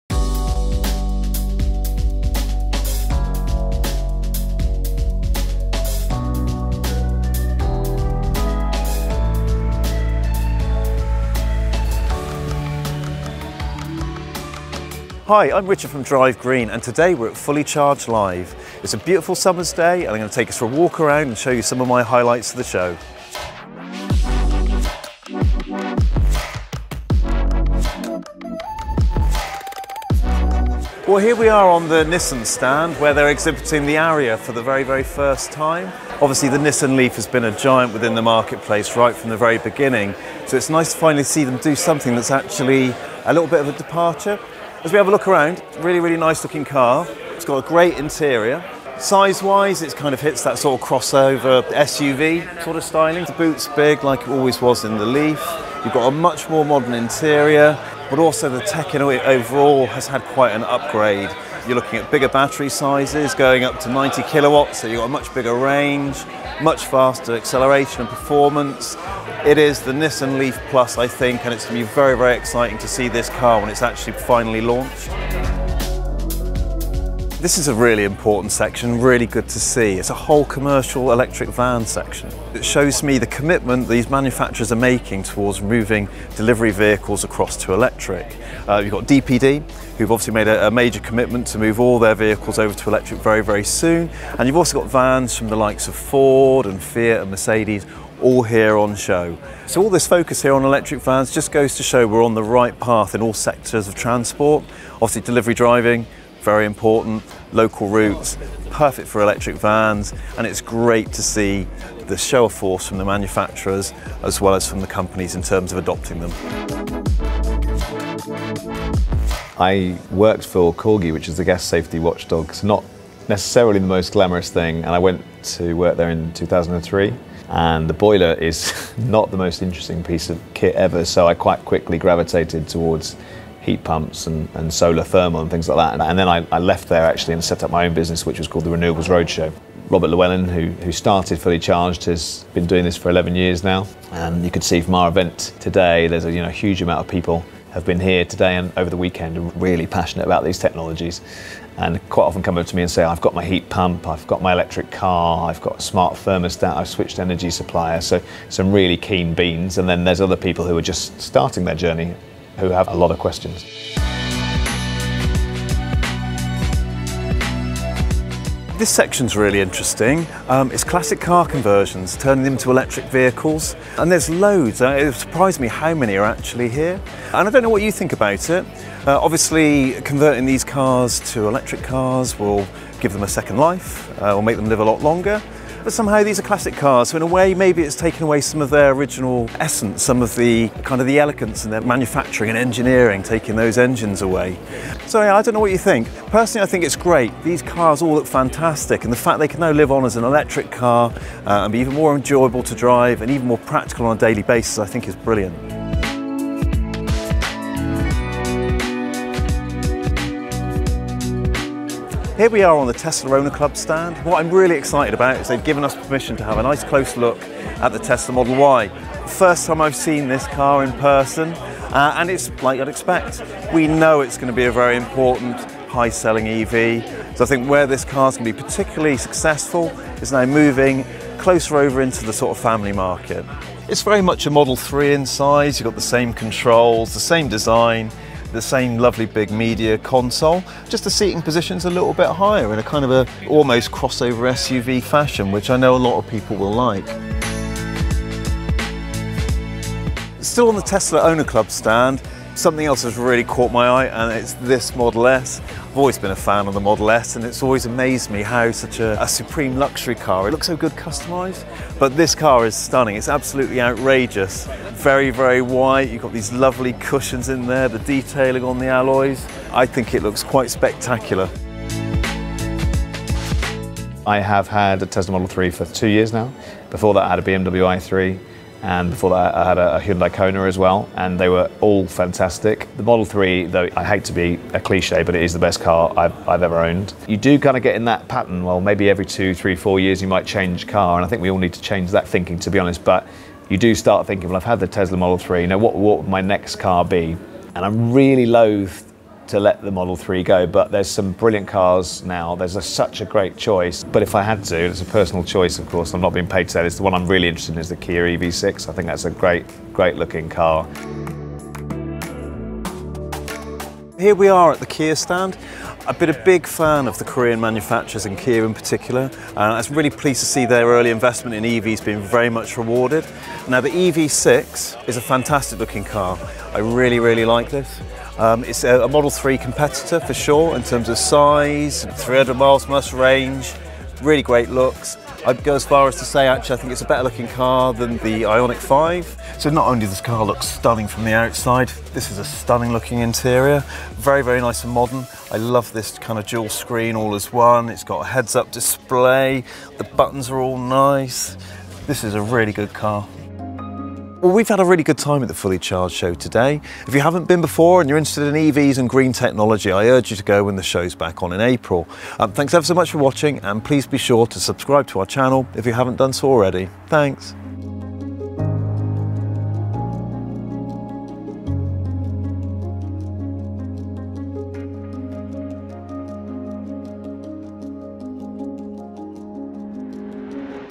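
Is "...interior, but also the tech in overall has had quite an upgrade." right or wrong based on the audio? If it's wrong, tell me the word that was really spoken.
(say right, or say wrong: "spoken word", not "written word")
right.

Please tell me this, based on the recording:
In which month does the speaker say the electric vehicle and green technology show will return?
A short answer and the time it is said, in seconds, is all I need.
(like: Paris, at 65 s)
April, at 361 s.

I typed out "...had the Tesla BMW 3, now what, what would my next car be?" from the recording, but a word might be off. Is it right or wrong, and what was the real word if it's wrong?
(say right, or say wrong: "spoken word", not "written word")
wrong: "Model", not "BMW".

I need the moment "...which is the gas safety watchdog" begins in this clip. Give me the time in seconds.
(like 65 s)
121 s.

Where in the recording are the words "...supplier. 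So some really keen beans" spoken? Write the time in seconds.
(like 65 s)
157 s.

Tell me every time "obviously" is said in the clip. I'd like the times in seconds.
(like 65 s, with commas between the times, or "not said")
36 s, 90 s, 104 s, 179 s.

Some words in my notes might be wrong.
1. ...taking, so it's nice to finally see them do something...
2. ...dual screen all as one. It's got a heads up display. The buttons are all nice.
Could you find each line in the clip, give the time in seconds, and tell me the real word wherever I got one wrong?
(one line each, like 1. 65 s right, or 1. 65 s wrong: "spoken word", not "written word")
1. 39 s wrong: "beginning", not "taking"
2. 346 s right.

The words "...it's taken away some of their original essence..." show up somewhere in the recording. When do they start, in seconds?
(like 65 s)
187 s.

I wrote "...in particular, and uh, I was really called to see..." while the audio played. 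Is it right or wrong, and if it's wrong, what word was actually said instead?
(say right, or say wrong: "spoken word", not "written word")
wrong: "pleased", not "called".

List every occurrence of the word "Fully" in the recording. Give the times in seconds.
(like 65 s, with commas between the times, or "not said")
17 s, 141 s, 355 s.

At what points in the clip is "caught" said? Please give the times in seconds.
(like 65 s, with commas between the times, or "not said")
253 s.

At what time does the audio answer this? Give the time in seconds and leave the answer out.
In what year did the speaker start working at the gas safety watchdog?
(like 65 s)
126 s.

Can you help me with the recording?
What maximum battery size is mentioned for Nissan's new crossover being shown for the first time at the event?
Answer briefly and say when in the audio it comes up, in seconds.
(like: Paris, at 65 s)
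90 kilowatts, at 63 s.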